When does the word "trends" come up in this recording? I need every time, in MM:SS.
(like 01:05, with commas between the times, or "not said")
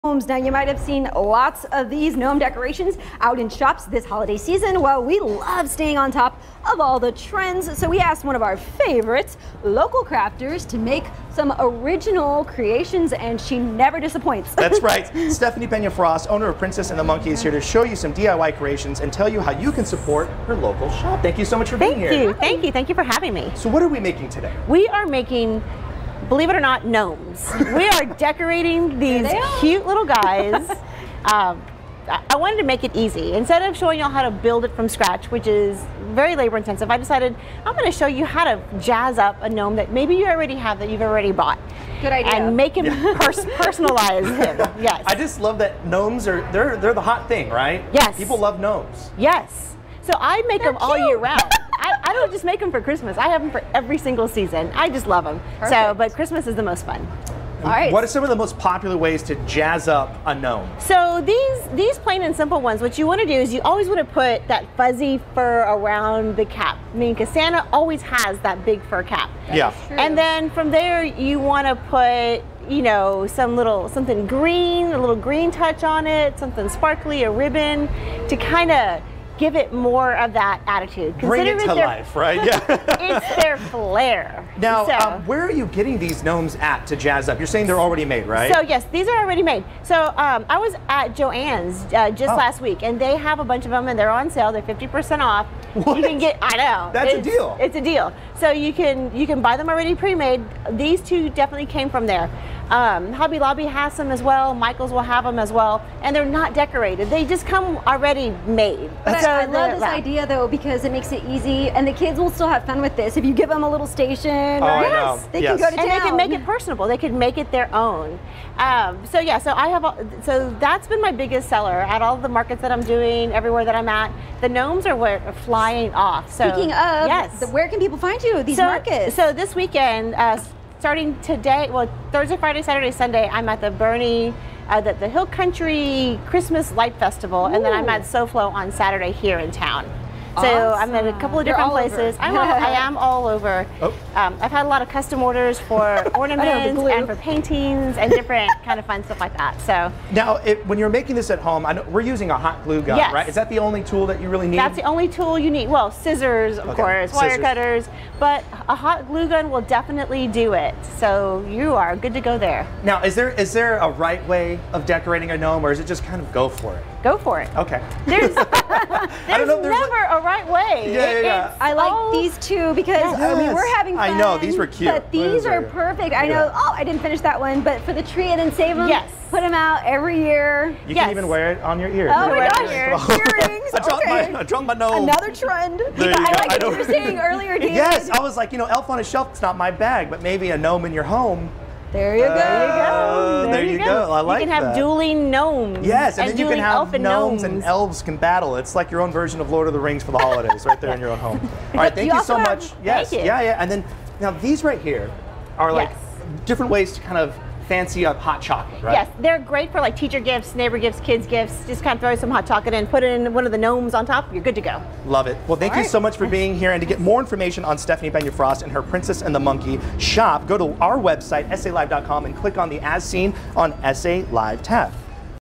00:07, 03:05.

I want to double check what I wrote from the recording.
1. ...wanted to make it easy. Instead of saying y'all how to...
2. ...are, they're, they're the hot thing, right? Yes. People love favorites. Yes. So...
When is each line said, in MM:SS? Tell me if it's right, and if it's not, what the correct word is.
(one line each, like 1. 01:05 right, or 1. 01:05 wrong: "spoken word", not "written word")
1. 00:32 wrong: "showing", not "saying"
2. 00:46 wrong: "gnomes", not "favorites".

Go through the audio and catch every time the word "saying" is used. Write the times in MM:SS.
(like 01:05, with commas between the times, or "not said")
01:27, 03:06.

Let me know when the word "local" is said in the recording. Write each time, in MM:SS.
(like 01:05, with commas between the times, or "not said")
00:09, 00:20.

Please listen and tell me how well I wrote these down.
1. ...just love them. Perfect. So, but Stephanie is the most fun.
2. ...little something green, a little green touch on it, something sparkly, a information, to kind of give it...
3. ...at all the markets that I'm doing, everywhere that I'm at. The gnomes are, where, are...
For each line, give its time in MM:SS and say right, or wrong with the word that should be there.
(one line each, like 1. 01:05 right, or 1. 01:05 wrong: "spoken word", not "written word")
1. 00:54 wrong: "Christmas", not "Stephanie"
2. 01:13 wrong: "ribbon", not "information"
3. 02:01 right.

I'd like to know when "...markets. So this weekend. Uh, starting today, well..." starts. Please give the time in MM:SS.
02:08.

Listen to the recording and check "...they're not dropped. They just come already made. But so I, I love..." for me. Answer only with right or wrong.
wrong.